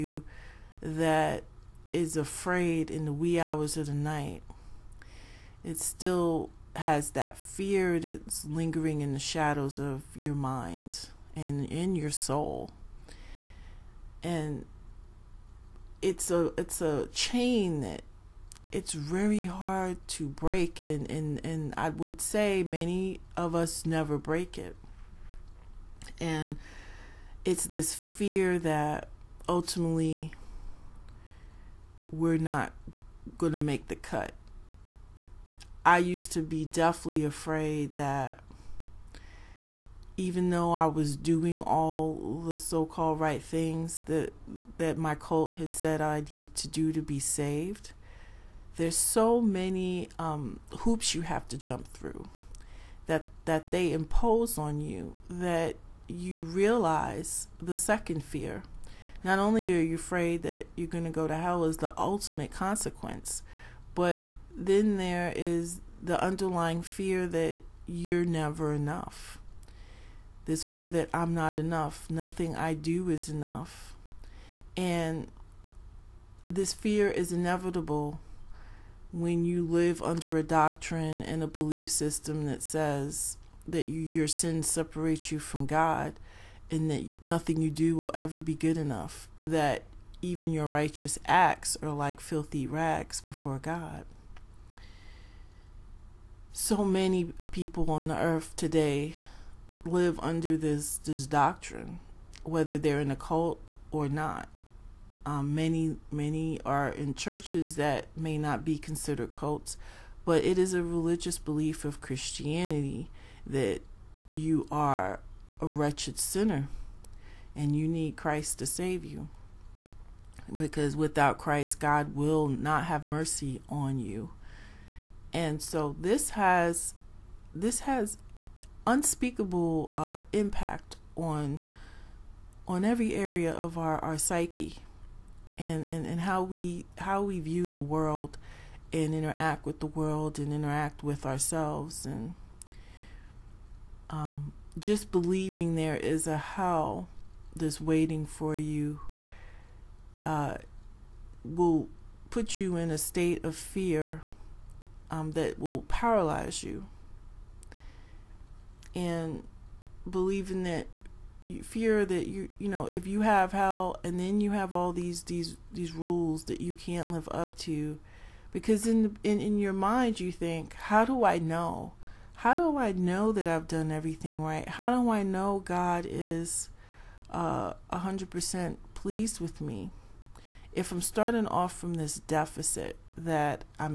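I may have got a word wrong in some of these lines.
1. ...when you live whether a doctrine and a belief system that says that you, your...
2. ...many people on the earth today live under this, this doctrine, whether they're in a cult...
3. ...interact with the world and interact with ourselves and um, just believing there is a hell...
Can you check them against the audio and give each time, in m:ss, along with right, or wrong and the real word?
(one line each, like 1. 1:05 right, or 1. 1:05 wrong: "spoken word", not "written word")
1. 1:19 wrong: "under", not "whether"
2. 1:36 right
3. 2:19 right.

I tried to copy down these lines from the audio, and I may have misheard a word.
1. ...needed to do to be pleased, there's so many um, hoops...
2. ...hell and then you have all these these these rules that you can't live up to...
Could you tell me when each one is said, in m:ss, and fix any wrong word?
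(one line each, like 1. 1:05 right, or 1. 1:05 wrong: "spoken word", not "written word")
1. 0:46 wrong: "saved", not "pleased"
2. 2:43 right.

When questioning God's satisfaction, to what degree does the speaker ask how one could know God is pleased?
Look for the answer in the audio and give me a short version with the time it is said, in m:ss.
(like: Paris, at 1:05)
100%, at 2:57.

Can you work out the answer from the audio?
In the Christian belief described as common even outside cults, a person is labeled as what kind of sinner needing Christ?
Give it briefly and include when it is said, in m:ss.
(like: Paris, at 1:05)
wretched sinner, at 1:55.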